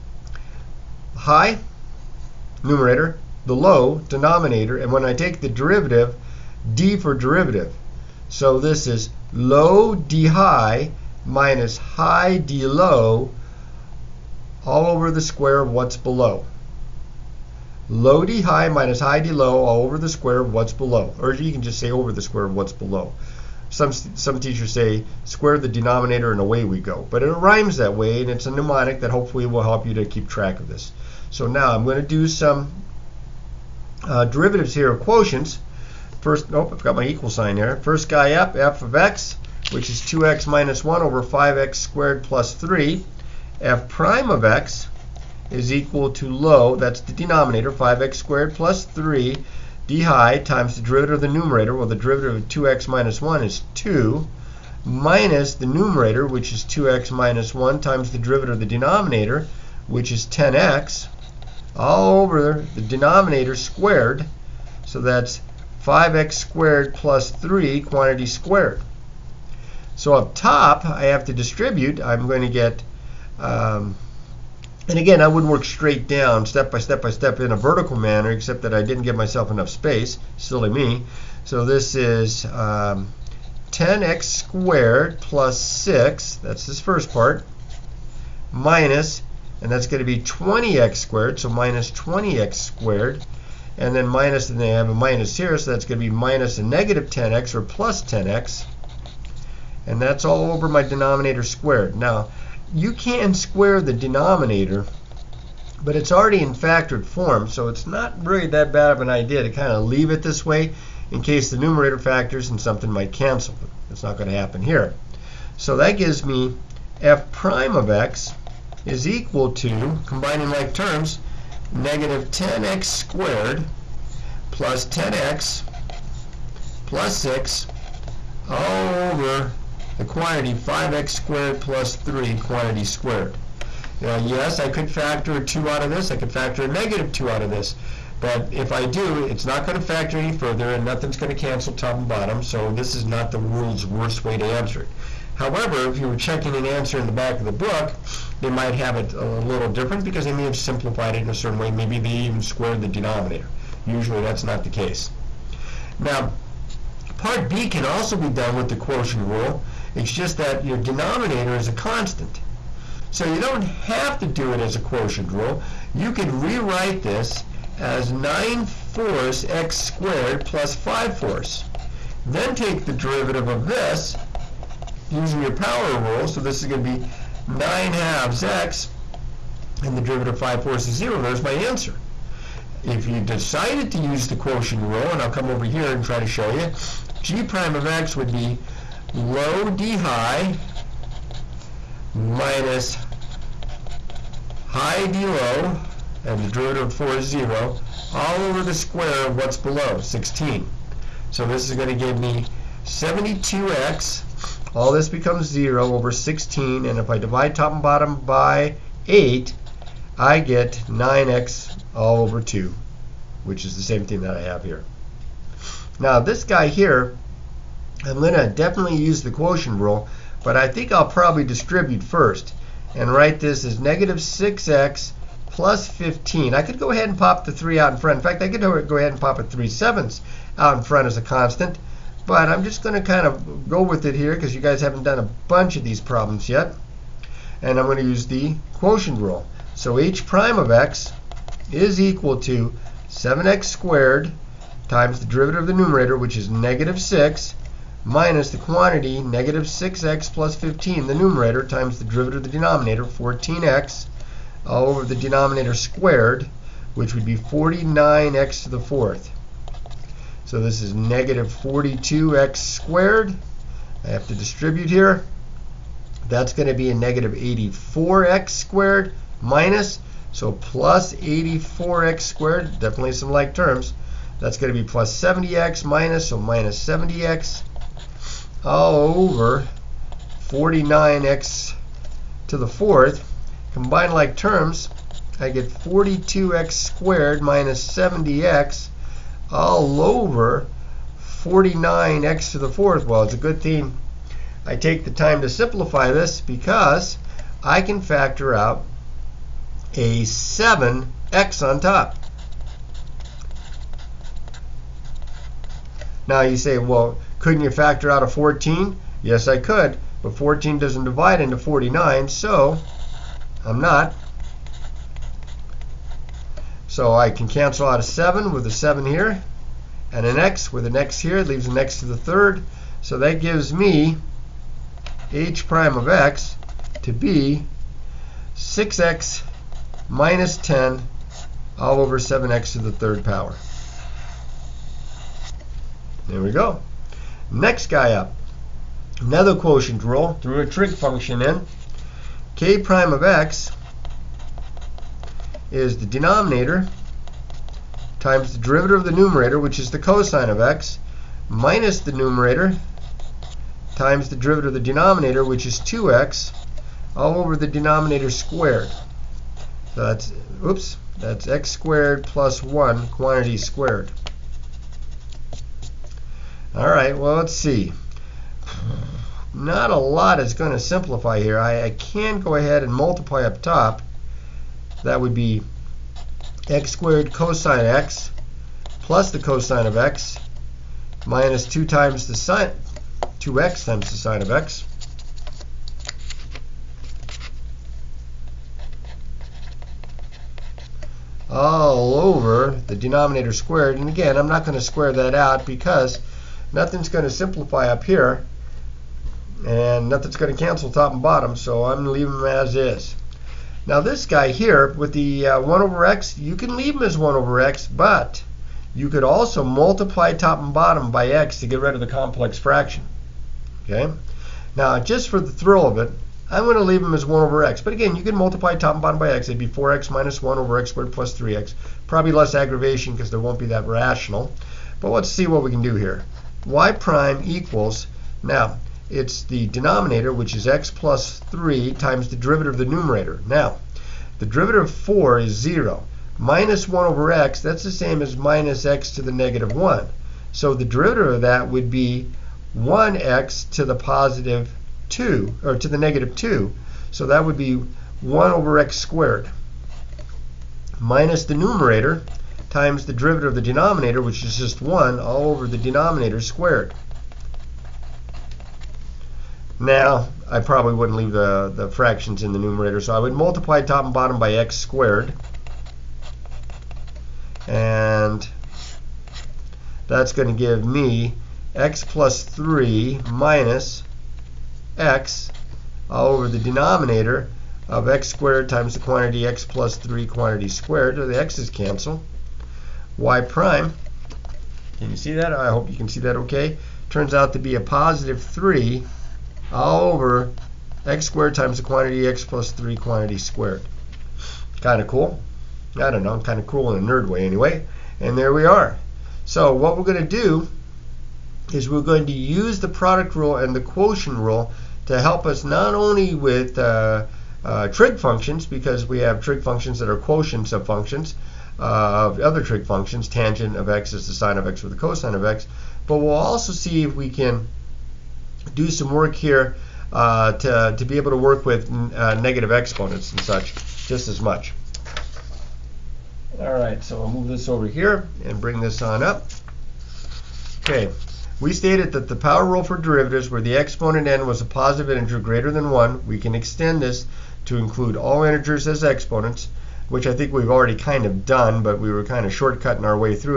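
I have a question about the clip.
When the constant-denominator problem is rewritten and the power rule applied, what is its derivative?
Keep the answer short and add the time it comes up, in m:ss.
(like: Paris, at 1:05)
9/2 x, at 2:57.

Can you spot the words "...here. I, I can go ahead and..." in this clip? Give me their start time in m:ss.
6:11.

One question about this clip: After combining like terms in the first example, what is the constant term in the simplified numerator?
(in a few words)
6.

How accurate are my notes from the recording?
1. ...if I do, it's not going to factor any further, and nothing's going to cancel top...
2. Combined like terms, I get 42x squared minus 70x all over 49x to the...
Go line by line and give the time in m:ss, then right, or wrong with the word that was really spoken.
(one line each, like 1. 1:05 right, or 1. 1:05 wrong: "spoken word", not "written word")
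1. 2:18 right
2. 4:43 right.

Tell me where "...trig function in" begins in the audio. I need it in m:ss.
5:40.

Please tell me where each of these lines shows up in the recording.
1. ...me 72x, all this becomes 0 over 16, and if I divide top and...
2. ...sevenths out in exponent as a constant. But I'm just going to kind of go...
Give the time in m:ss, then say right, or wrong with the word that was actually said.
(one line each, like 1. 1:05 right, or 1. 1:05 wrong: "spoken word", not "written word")
1. 3:22 right
2. 3:49 wrong: "front", not "exponent".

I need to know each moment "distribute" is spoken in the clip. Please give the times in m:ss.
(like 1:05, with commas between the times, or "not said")
1:11, 3:41, 4:24.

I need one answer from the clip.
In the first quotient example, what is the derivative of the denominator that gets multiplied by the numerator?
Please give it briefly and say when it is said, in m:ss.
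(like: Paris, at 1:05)
10x, at 0:59.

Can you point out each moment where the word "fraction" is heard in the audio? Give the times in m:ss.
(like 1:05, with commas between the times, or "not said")
6:52, 7:41.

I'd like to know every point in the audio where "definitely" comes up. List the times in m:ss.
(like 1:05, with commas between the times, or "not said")
3:38, 4:32.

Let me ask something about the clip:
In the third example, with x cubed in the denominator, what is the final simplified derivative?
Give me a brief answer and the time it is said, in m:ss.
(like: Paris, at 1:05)
(6x - 10)/(7x^3), at 5:28.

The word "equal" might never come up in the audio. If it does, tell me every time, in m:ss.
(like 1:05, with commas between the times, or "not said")
0:37, 0:45, 1:59, 4:01, 7:07.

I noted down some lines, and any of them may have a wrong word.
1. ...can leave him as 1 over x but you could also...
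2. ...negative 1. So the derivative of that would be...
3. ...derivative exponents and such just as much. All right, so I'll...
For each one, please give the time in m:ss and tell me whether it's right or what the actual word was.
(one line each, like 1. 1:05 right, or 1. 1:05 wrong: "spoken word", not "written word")
1. 6:46 right
2. 7:19 right
3. 8:42 wrong: "negative", not "derivative".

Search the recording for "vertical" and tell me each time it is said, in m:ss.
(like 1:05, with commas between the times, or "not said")
1:17.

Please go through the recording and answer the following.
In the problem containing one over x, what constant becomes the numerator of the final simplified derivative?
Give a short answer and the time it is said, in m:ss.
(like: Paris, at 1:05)
3, at 8:07.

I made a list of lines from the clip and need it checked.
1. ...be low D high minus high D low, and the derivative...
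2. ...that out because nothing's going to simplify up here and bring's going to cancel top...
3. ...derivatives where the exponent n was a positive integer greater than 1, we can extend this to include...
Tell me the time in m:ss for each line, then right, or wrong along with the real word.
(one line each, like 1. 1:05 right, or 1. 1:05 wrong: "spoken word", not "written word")
1. 3:08 right
2. 6:35 wrong: "nothing", not "bring"
3. 8:52 right.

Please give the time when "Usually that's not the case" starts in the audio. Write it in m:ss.
2:33.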